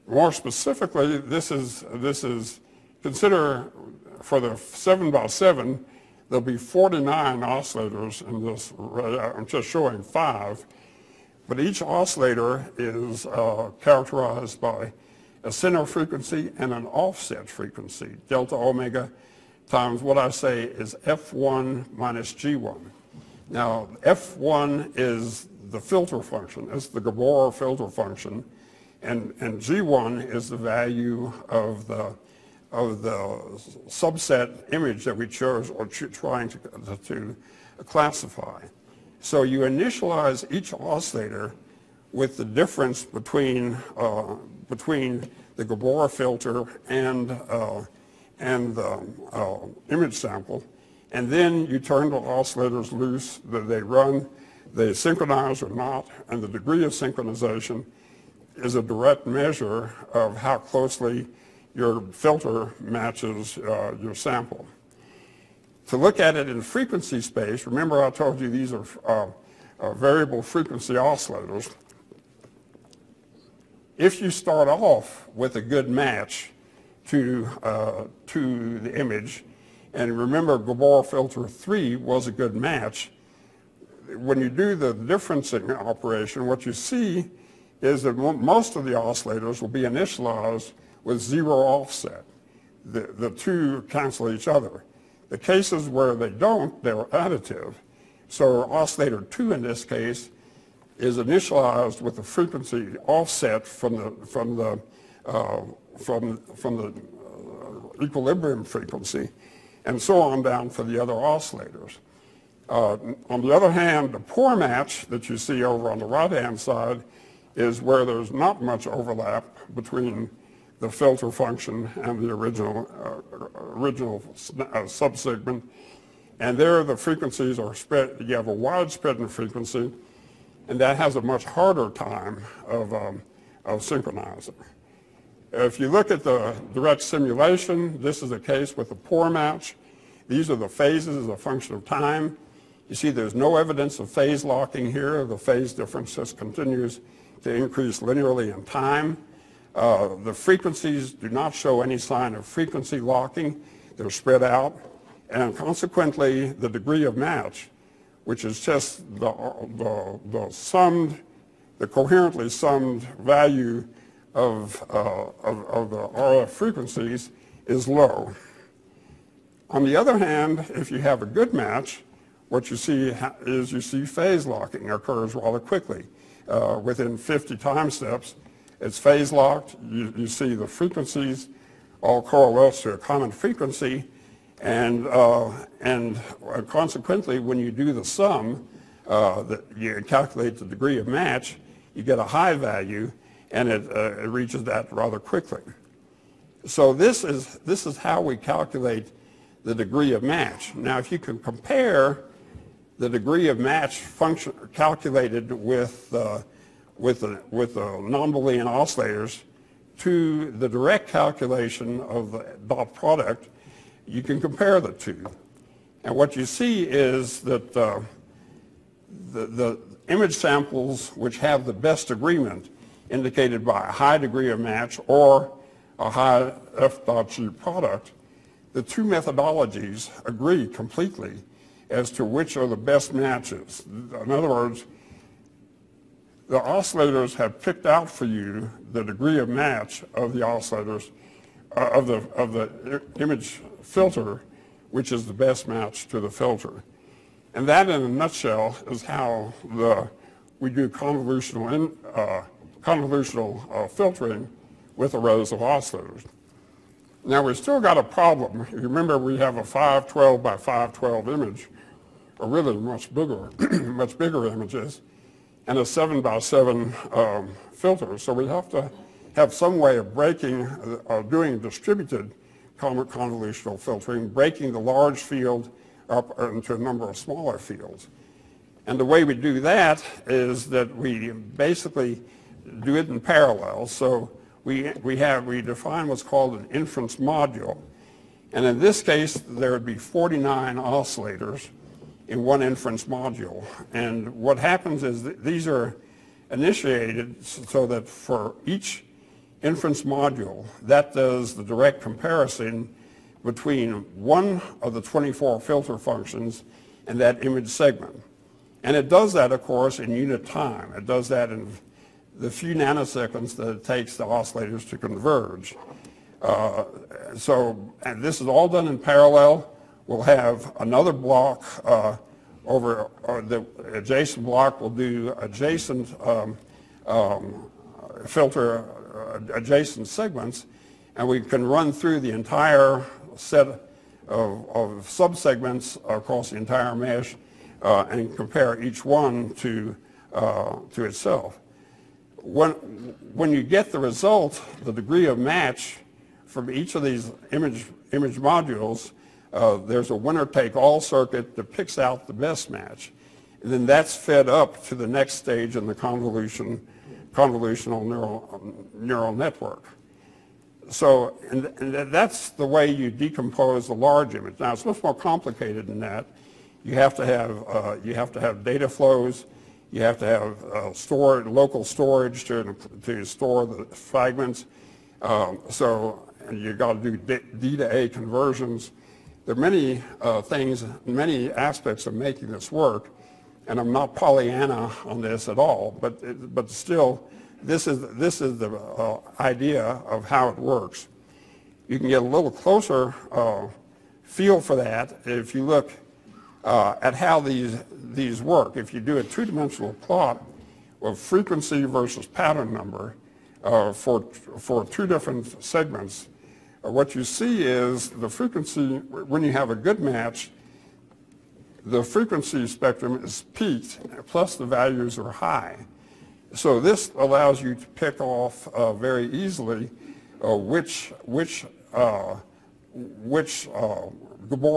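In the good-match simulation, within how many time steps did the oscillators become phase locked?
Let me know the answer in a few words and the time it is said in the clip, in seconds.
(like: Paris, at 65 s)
50, at 177 s.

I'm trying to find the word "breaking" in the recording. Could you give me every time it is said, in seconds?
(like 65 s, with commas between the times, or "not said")
270 s, 274 s.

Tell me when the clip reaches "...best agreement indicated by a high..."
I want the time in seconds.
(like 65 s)
221 s.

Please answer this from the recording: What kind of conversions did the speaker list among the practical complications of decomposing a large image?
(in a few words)
D to A conversions.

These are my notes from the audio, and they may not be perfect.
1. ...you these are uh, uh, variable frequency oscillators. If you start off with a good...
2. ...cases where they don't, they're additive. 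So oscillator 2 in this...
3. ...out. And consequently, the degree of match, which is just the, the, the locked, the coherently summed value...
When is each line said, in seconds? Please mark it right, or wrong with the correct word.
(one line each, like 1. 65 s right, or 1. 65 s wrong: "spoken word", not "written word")
1. 68 s right
2. 95 s right
3. 154 s wrong: "summed", not "locked".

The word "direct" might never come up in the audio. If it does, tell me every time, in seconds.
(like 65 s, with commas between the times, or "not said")
58 s, 136 s, 210 s, 301 s.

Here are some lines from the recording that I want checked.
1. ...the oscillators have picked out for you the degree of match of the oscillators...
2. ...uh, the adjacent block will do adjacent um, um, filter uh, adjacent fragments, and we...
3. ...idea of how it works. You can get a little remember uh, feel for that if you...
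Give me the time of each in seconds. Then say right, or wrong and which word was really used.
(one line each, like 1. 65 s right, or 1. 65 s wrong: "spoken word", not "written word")
1. 236 s right
2. 323 s wrong: "segments", not "fragments"
3. 389 s wrong: "closer", not "remember".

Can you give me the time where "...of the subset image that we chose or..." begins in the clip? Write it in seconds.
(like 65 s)
32 s.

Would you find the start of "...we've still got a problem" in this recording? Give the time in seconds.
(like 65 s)
257 s.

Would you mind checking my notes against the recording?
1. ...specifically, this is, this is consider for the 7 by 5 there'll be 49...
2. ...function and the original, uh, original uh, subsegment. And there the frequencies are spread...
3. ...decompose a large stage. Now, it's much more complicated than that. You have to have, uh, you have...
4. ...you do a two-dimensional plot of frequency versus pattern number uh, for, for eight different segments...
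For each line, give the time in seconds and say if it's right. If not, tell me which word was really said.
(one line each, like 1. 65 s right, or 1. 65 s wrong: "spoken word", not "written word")
1. 0 s wrong: "7", not "5"
2. 121 s right
3. 363 s wrong: "image", not "stage"
4. 398 s wrong: "two", not "eight".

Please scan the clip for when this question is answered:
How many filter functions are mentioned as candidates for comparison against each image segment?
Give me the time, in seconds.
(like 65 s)
305 s.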